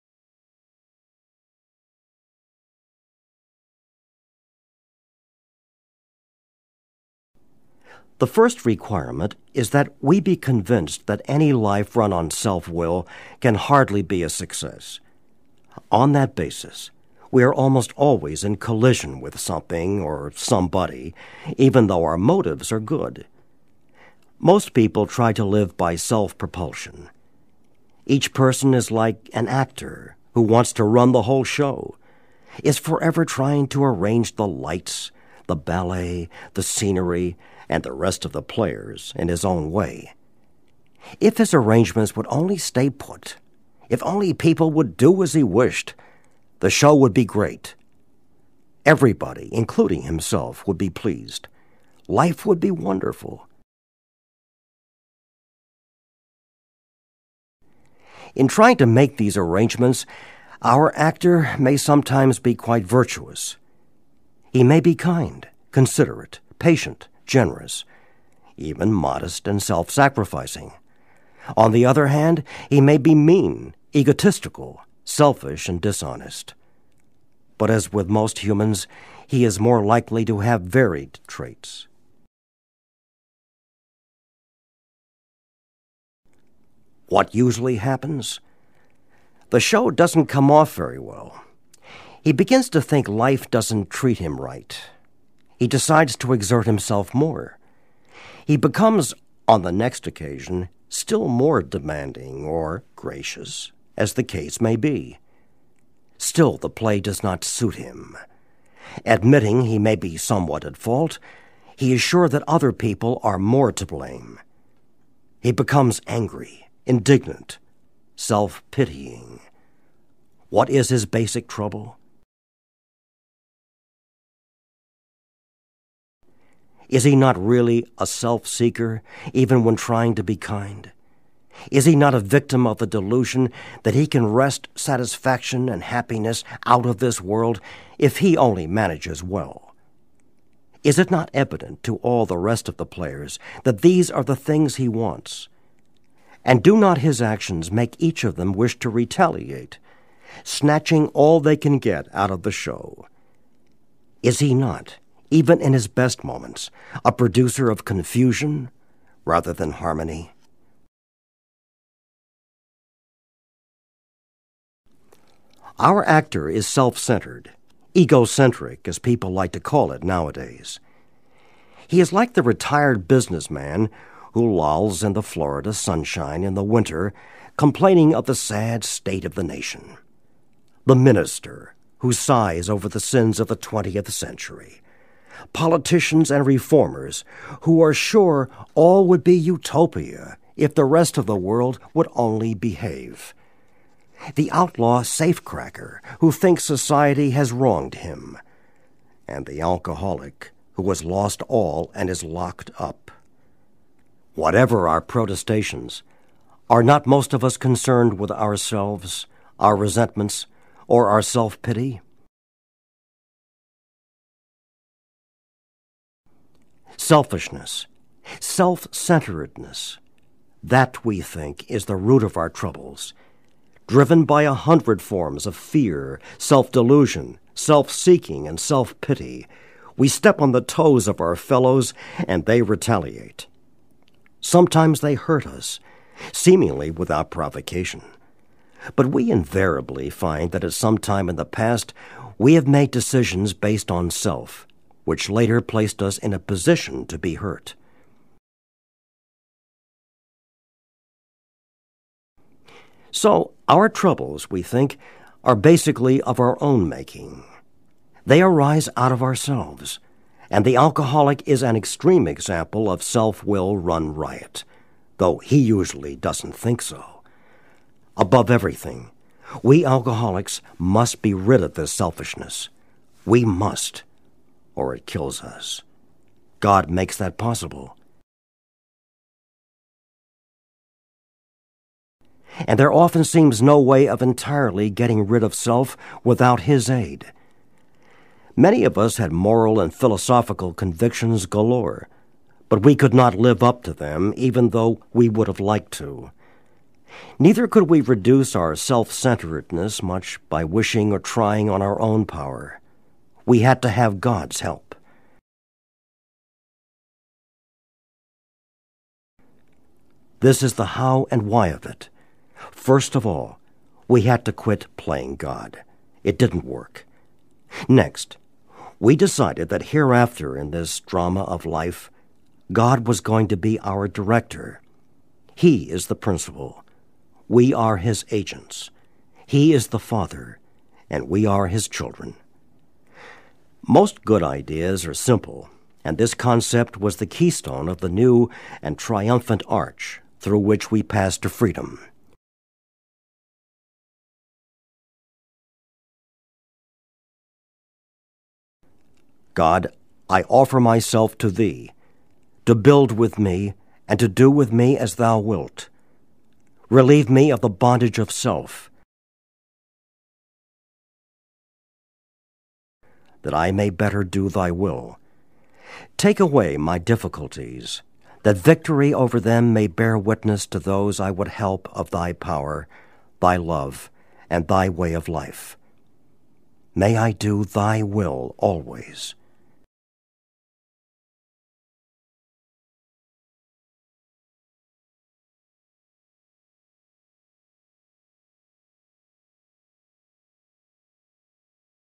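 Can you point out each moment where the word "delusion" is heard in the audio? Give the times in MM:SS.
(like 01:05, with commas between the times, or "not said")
02:12, 03:46.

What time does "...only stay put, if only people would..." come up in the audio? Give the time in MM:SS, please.
00:42.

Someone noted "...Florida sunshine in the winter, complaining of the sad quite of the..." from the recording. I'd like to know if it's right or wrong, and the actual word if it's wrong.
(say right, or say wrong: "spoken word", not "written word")
wrong: "state", not "quite".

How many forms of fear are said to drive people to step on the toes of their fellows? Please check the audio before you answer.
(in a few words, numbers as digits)
100.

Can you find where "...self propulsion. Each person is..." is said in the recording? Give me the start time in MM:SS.
00:25.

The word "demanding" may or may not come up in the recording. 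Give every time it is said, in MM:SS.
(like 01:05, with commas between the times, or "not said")
01:41.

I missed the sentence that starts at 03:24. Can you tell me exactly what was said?
Whatever our protestations, are not most of us concerned with ourselves, our resentments, or our self pity?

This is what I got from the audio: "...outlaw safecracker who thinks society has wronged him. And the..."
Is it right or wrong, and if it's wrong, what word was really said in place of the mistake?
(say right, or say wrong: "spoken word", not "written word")
right.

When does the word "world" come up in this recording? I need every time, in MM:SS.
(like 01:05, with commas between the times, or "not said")
02:17, 03:11.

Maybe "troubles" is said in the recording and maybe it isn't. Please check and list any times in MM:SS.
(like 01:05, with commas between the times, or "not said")
02:01, 03:42, 04:13.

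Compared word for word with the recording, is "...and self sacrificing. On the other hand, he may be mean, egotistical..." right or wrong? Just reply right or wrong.
right.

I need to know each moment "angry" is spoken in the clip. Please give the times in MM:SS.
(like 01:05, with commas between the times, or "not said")
01:56.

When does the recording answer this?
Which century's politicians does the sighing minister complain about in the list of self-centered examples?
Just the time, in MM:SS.
03:03.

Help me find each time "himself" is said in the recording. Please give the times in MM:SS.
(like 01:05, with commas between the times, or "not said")
00:50, 01:36.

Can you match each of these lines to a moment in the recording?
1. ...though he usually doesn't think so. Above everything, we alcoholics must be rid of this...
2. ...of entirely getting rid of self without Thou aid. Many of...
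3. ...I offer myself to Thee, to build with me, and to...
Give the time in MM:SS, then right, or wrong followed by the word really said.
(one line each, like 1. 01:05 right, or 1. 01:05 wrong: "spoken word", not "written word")
1. 04:25 right
2. 04:44 wrong: "His", not "Thou"
3. 05:50 right.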